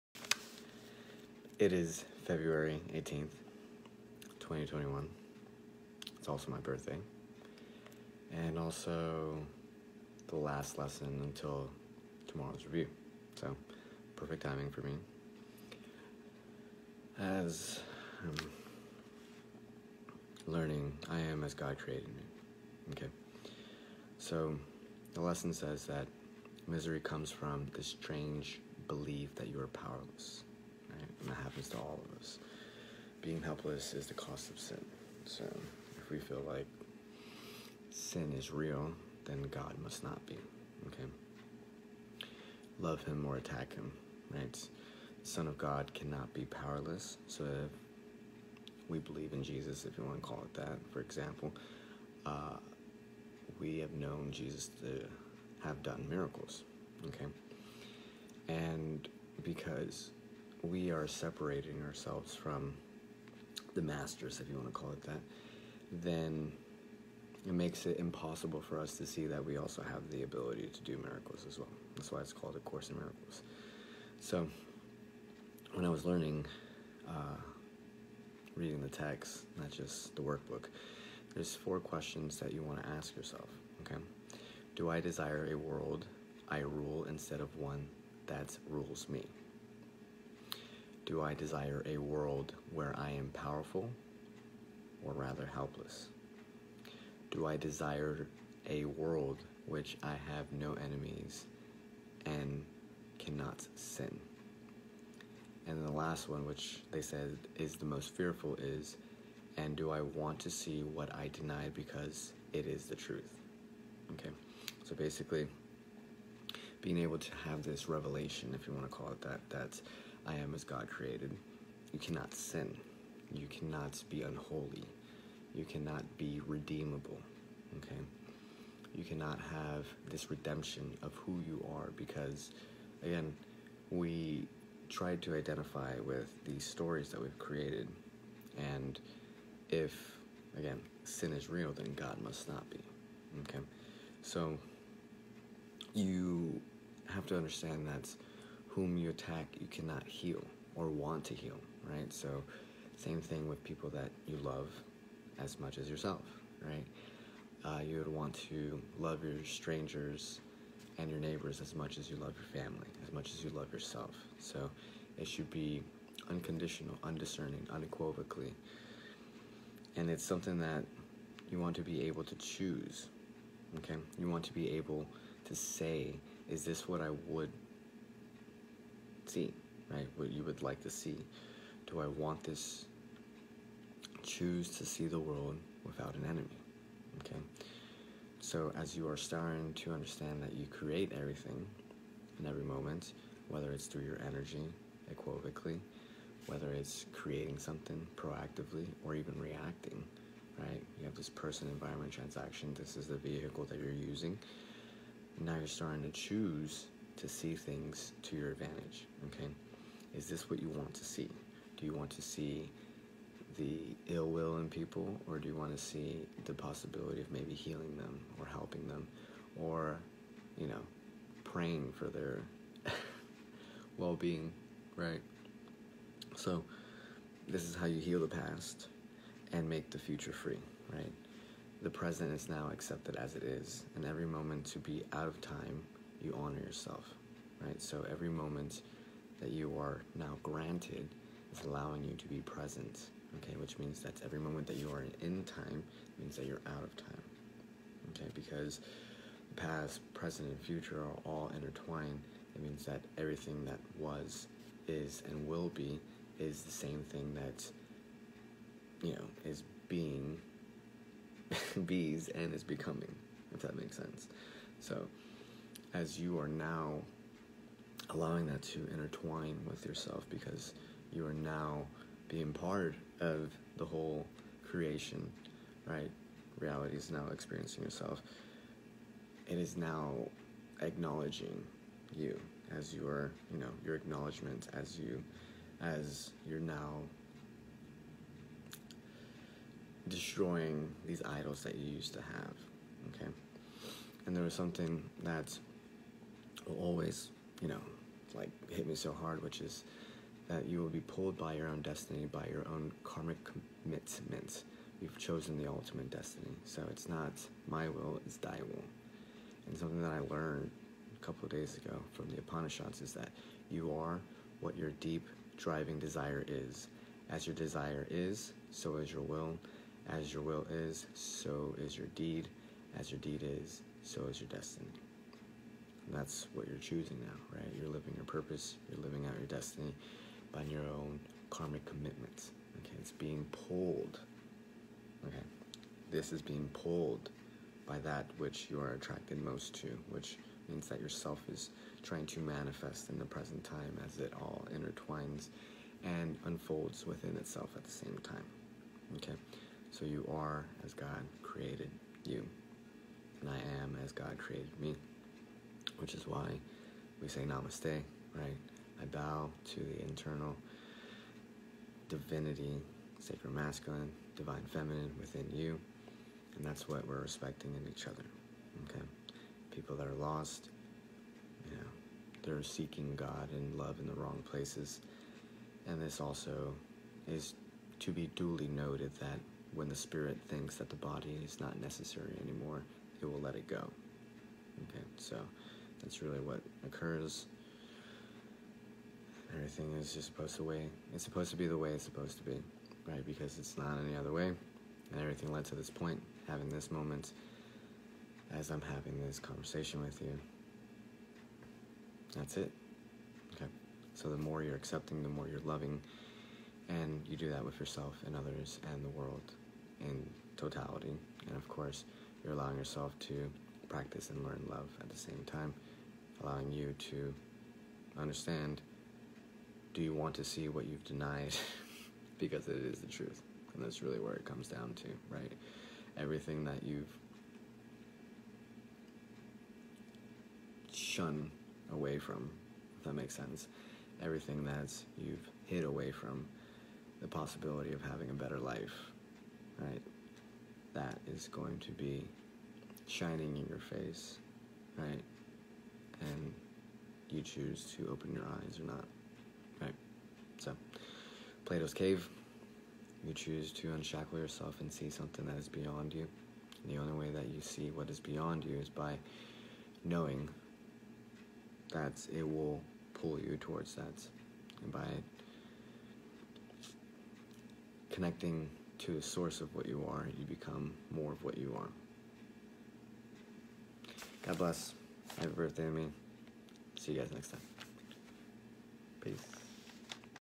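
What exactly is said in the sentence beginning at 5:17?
As your desire is, so is your will.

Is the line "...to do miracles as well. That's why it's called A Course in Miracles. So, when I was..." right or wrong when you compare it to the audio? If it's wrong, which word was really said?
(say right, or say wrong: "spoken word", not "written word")
right.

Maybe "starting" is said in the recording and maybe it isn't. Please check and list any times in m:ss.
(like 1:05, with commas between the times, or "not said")
3:09, 3:25.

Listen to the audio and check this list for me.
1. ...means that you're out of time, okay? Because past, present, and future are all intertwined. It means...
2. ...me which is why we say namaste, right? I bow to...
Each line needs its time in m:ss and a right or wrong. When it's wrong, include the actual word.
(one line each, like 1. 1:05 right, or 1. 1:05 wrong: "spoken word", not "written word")
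1. 4:06 right
2. 5:54 right.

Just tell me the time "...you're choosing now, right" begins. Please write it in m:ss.
5:26.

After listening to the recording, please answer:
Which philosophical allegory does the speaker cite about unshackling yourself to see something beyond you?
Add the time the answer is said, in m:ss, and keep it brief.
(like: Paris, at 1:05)
Plato's Cave, at 7:31.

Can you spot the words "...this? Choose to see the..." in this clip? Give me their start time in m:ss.
3:02.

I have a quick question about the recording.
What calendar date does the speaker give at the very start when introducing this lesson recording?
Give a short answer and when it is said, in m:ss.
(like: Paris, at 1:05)
February 18th, 2021, at 0:02.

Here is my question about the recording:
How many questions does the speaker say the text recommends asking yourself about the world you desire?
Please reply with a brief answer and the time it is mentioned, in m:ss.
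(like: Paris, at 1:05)
4, at 1:21.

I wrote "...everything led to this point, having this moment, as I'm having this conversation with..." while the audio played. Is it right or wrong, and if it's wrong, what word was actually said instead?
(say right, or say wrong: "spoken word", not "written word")
right.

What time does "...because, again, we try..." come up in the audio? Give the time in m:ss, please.
2:11.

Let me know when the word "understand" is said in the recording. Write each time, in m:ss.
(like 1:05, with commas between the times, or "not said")
2:27, 3:09, 6:58.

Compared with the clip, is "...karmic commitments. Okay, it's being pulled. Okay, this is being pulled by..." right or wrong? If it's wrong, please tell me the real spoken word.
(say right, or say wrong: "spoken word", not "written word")
right.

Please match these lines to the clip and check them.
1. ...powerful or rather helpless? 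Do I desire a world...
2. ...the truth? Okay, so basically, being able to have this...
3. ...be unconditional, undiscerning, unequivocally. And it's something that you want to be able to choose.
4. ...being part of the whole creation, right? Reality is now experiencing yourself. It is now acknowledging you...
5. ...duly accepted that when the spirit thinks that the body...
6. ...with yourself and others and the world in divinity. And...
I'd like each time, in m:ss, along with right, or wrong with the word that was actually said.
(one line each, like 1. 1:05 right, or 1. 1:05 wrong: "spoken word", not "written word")
1. 1:33 right
2. 1:52 right
3. 2:45 right
4. 4:32 right
5. 6:18 wrong: "noted", not "accepted"
6. 6:47 wrong: "totality", not "divinity".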